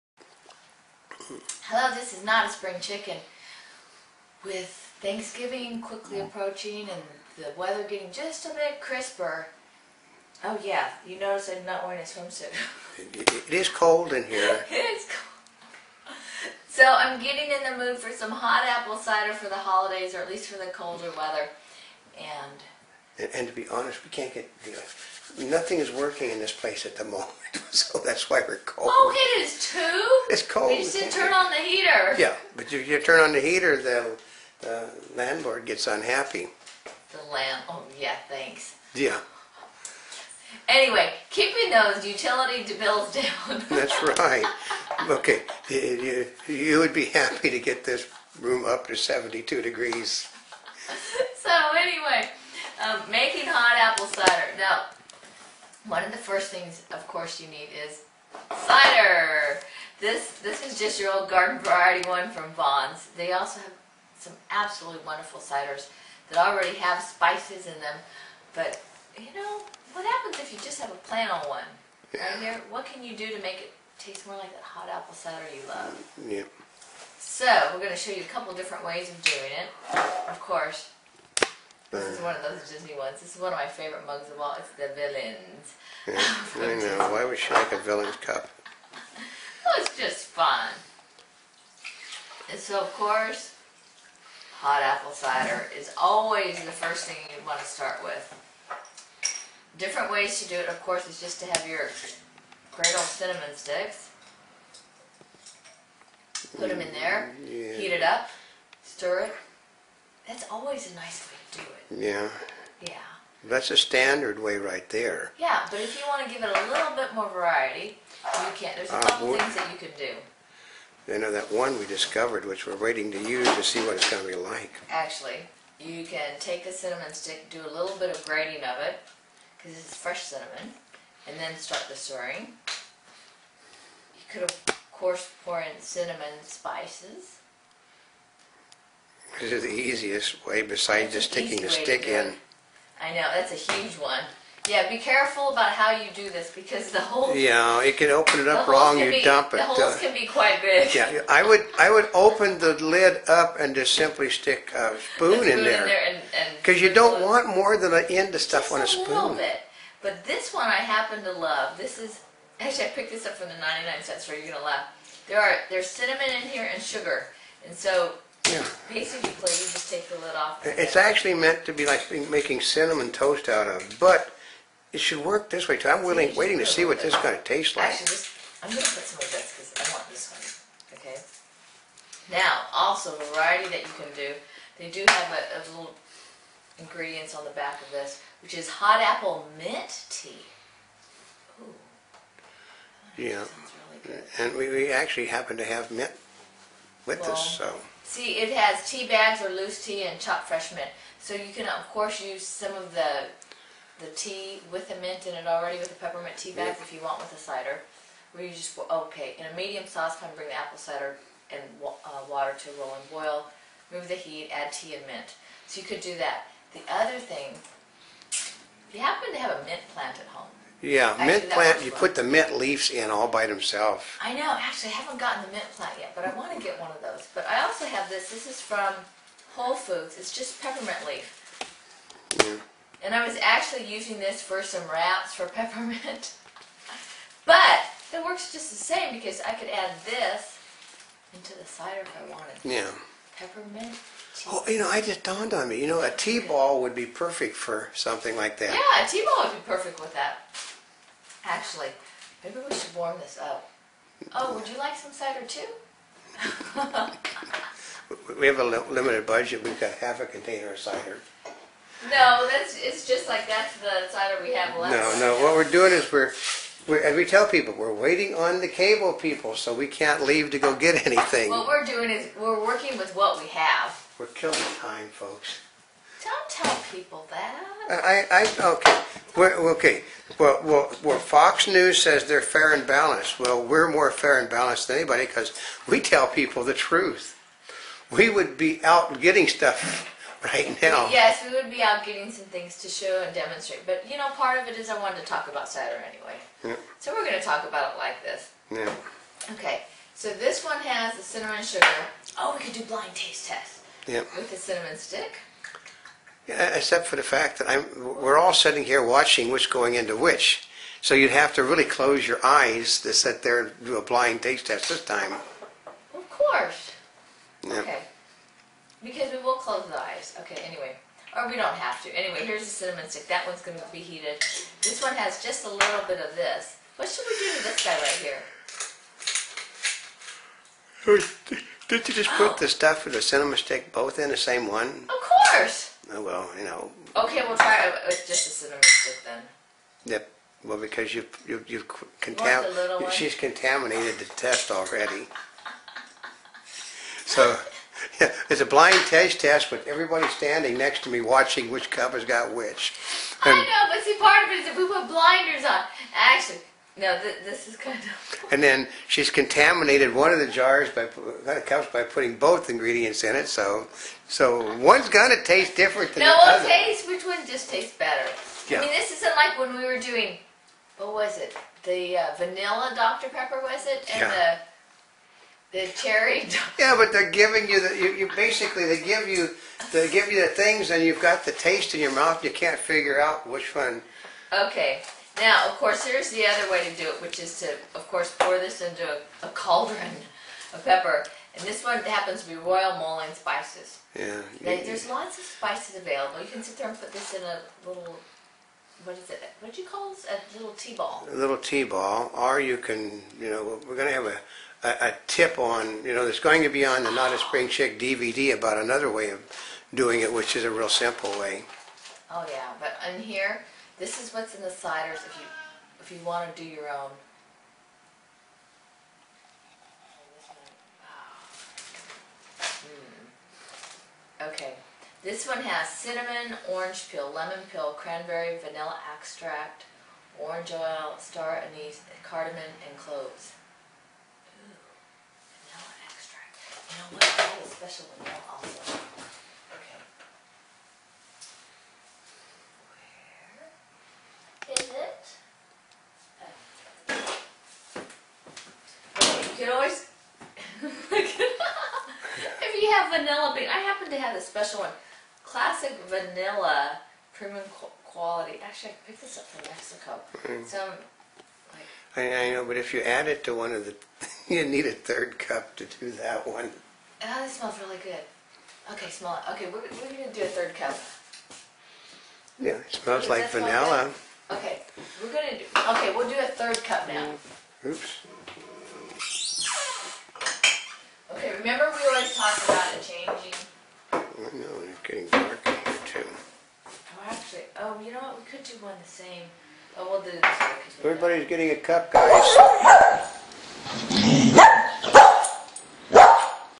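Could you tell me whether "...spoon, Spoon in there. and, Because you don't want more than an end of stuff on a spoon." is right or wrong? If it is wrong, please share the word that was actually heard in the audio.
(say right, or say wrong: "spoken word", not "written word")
right.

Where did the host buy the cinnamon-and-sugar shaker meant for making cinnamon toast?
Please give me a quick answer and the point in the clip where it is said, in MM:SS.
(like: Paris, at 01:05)
The 99 cent store, at 02:43.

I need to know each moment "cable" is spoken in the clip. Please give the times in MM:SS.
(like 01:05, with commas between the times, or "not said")
04:28.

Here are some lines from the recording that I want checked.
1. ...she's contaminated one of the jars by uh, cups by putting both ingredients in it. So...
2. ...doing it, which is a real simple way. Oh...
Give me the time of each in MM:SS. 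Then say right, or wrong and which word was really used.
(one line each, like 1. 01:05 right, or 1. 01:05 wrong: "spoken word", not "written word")
1. 05:59 right
2. 06:49 right.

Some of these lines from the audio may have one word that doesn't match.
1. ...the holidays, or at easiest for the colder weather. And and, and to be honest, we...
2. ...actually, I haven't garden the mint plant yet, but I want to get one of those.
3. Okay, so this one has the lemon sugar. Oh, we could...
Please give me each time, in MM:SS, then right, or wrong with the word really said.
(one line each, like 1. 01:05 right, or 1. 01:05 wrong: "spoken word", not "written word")
1. 00:19 wrong: "least", not "easiest"
2. 03:44 wrong: "gotten", not "garden"
3. 04:59 wrong: "cinnamon", not "lemon".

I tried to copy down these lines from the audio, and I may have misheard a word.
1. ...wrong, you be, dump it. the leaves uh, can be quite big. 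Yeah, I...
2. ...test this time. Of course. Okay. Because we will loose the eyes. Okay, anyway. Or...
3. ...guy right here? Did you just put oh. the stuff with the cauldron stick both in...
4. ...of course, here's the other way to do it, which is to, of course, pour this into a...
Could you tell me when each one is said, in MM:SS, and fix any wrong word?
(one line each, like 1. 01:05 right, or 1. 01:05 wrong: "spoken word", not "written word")
1. 02:28 wrong: "holes", not "leaves"
2. 05:14 wrong: "close", not "loose"
3. 05:27 wrong: "cinnamon", not "cauldron"
4. 06:25 right.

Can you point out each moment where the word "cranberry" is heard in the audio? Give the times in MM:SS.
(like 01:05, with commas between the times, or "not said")
07:07.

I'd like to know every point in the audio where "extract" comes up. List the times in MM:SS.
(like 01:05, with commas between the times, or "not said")
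07:09, 07:16.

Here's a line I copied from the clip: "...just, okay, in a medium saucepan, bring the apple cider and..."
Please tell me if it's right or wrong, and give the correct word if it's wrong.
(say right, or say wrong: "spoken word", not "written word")
right.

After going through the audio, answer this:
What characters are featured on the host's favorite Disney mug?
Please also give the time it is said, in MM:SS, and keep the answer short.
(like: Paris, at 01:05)
The villains, at 01:24.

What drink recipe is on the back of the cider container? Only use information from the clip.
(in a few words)
Hot apple mint tea.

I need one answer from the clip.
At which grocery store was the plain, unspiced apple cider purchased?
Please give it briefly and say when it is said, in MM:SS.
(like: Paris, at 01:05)
Vons, at 01:02.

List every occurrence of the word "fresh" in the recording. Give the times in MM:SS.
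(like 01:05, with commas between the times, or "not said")
02:09, 03:20.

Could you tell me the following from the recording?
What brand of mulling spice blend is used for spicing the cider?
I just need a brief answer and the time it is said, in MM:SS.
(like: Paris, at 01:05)
Royal Mulling Spices, at 06:32.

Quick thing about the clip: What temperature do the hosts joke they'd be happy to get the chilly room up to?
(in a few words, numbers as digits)
72 degrees.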